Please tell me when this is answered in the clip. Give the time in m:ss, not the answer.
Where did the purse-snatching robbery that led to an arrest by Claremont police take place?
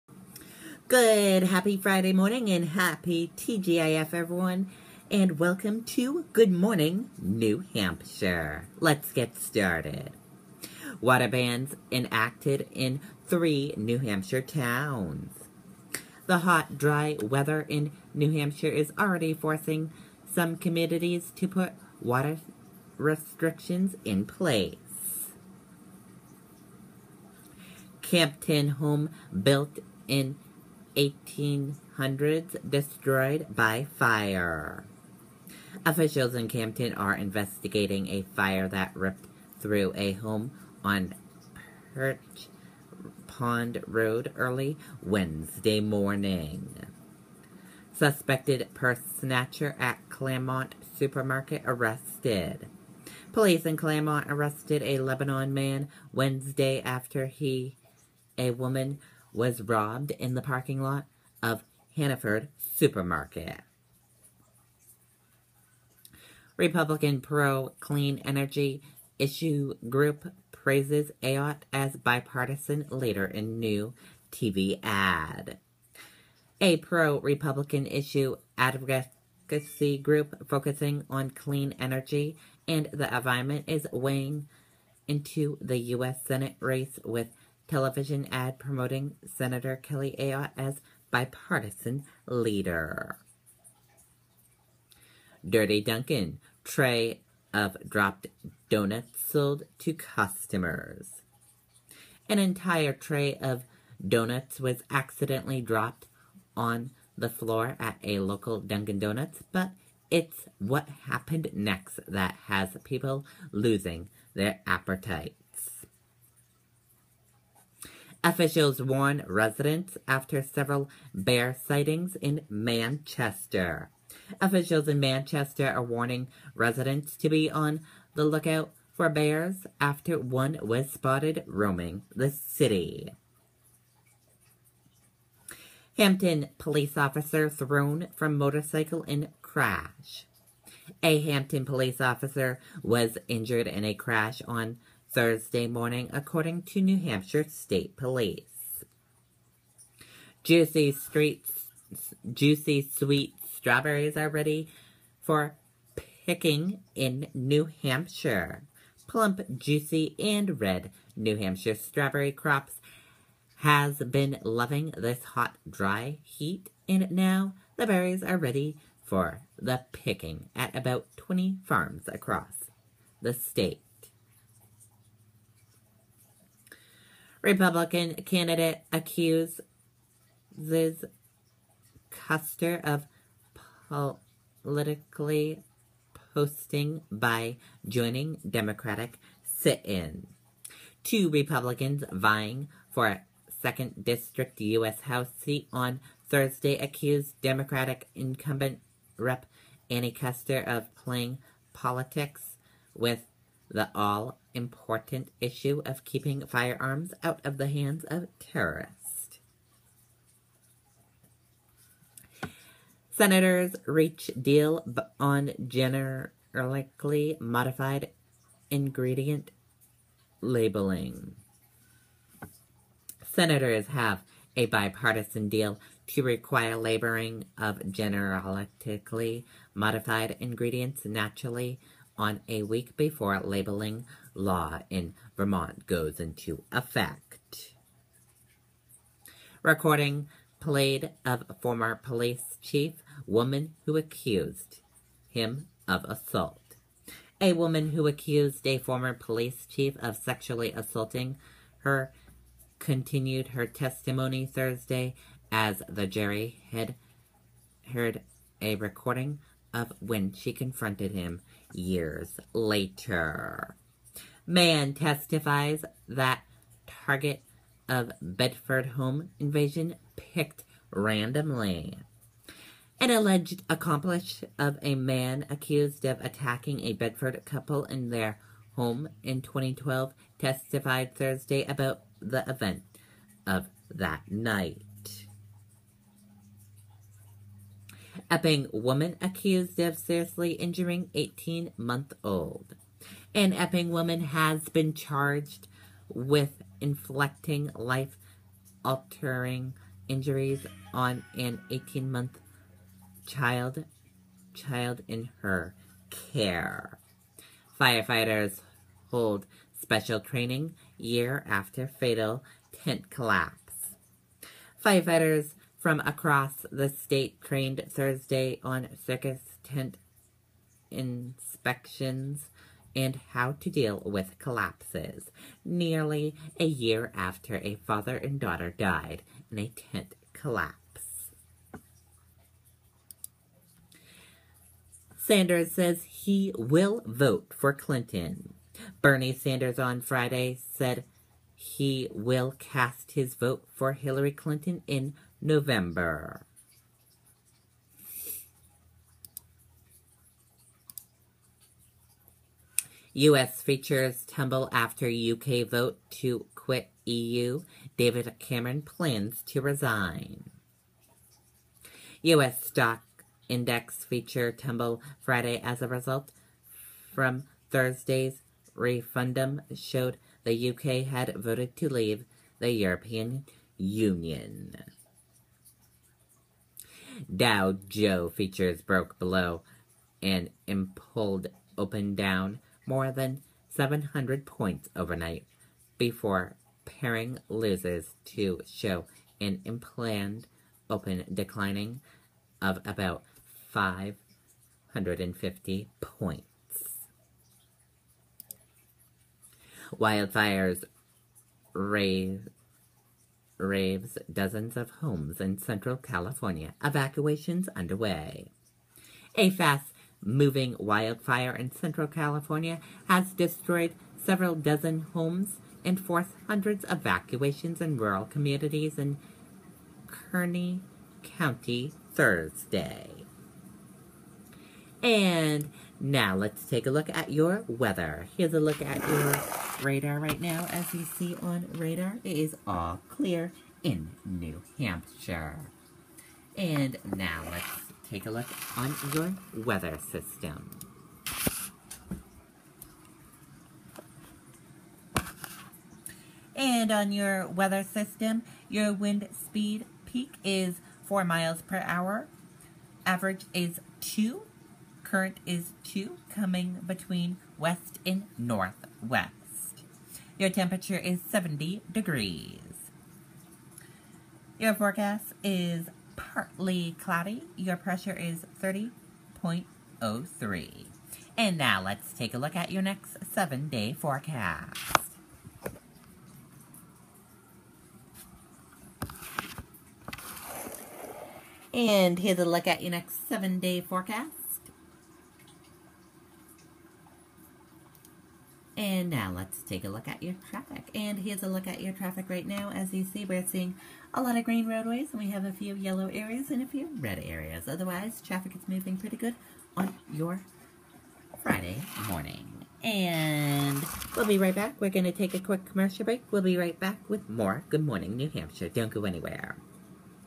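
1:01.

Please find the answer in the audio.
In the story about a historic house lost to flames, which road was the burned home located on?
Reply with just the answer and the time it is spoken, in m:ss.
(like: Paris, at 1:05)
Perch Pond Road, at 0:41.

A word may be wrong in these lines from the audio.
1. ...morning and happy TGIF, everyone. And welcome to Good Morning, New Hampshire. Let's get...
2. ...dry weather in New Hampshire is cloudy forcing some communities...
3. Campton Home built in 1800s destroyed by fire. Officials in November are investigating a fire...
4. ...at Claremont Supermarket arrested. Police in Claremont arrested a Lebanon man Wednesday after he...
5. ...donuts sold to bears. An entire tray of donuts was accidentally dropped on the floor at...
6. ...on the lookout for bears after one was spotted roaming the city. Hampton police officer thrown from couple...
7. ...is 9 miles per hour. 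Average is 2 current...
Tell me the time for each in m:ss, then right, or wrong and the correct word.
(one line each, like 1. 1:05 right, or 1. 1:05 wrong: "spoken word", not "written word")
1. 0:02 right
2. 0:16 wrong: "already", not "cloudy"
3. 0:28 wrong: "Campton", not "November"
4. 0:49 right
5. 1:38 wrong: "customers", not "bears"
6. 2:07 wrong: "motorcycle", not "couple"
7. 7:30 wrong: "4", not "9".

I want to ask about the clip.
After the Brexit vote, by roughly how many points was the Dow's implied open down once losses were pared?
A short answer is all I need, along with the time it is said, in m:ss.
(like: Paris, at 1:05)
550, at 6:32.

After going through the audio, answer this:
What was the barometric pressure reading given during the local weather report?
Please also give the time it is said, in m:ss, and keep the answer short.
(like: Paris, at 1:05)
30.03, at 7:48.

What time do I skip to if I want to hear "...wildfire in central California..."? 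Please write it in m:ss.
6:50.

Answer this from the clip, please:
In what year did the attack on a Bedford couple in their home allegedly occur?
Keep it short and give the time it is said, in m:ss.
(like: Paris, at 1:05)
2012, at 4:39.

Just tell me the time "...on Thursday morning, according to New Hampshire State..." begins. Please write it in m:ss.
2:24.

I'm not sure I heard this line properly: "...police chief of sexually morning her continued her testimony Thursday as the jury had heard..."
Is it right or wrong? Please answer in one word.
wrong.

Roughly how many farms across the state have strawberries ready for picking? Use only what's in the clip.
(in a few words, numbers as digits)
20.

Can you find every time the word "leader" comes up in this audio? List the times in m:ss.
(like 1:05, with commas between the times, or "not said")
1:12, 1:32.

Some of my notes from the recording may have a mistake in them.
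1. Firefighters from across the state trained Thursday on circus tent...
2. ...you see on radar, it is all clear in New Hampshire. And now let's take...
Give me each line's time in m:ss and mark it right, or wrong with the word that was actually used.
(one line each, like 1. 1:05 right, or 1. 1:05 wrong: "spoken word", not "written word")
1. 5:14 right
2. 7:10 right.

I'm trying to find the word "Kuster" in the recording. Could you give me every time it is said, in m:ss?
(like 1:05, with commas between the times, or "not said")
3:02, 3:20.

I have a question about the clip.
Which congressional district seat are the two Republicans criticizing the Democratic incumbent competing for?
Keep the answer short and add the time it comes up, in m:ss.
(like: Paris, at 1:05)
2nd District, at 3:13.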